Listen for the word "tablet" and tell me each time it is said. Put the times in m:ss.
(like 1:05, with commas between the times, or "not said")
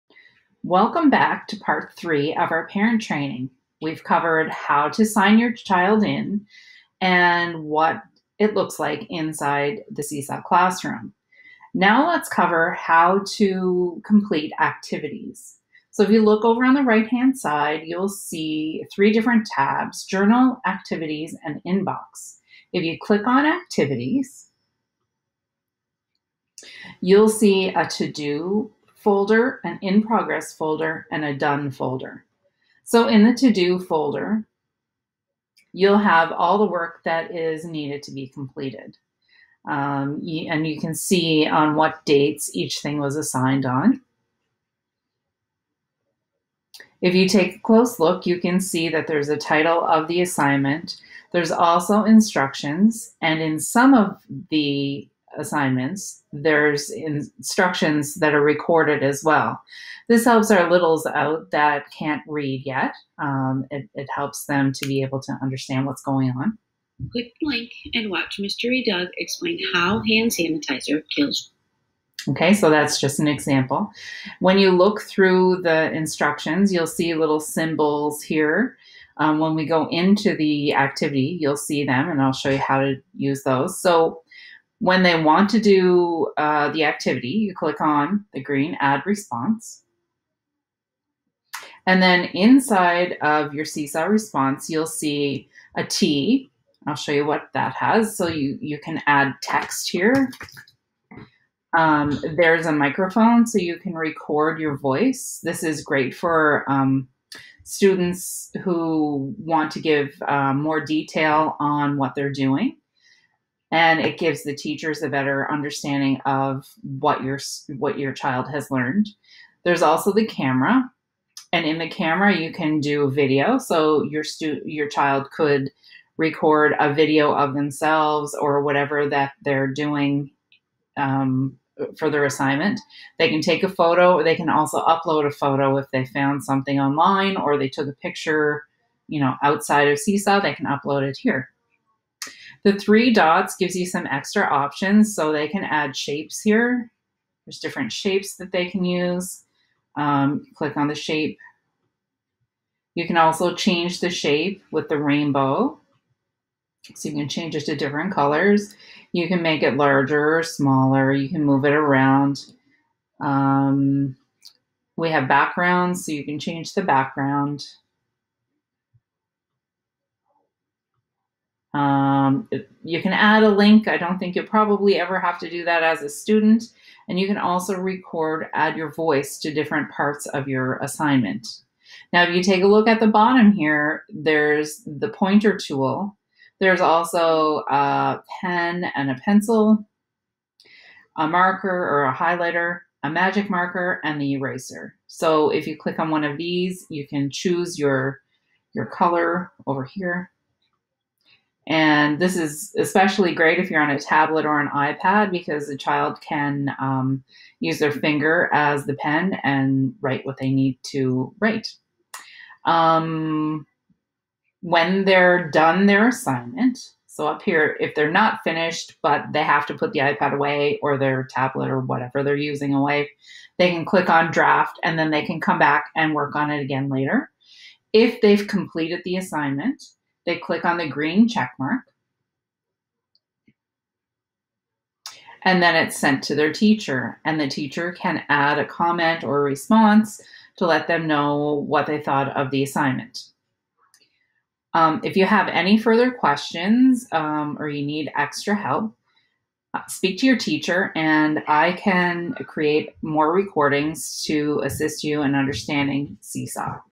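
3:23, 3:41.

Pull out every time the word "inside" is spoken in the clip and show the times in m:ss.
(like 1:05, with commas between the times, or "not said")
0:09, 1:32.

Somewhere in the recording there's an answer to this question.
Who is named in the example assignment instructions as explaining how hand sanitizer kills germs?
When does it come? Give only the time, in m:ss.
1:08.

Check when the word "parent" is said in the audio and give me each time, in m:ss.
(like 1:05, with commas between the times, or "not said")
0:02.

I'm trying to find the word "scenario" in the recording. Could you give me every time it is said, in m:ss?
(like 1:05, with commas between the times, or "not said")
not said.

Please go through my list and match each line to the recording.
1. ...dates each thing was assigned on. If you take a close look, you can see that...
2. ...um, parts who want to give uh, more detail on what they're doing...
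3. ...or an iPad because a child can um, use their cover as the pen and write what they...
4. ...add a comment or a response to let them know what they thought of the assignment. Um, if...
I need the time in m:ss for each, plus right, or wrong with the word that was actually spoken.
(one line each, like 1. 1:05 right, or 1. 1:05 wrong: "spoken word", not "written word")
1. 0:42 right
2. 1:46 wrong: "students", not "parts"
3. 3:24 wrong: "finger", not "cover"
4. 3:58 right.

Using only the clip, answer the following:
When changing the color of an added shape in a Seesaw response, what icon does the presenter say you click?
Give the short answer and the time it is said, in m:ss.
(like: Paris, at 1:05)
rainbow, at 2:34.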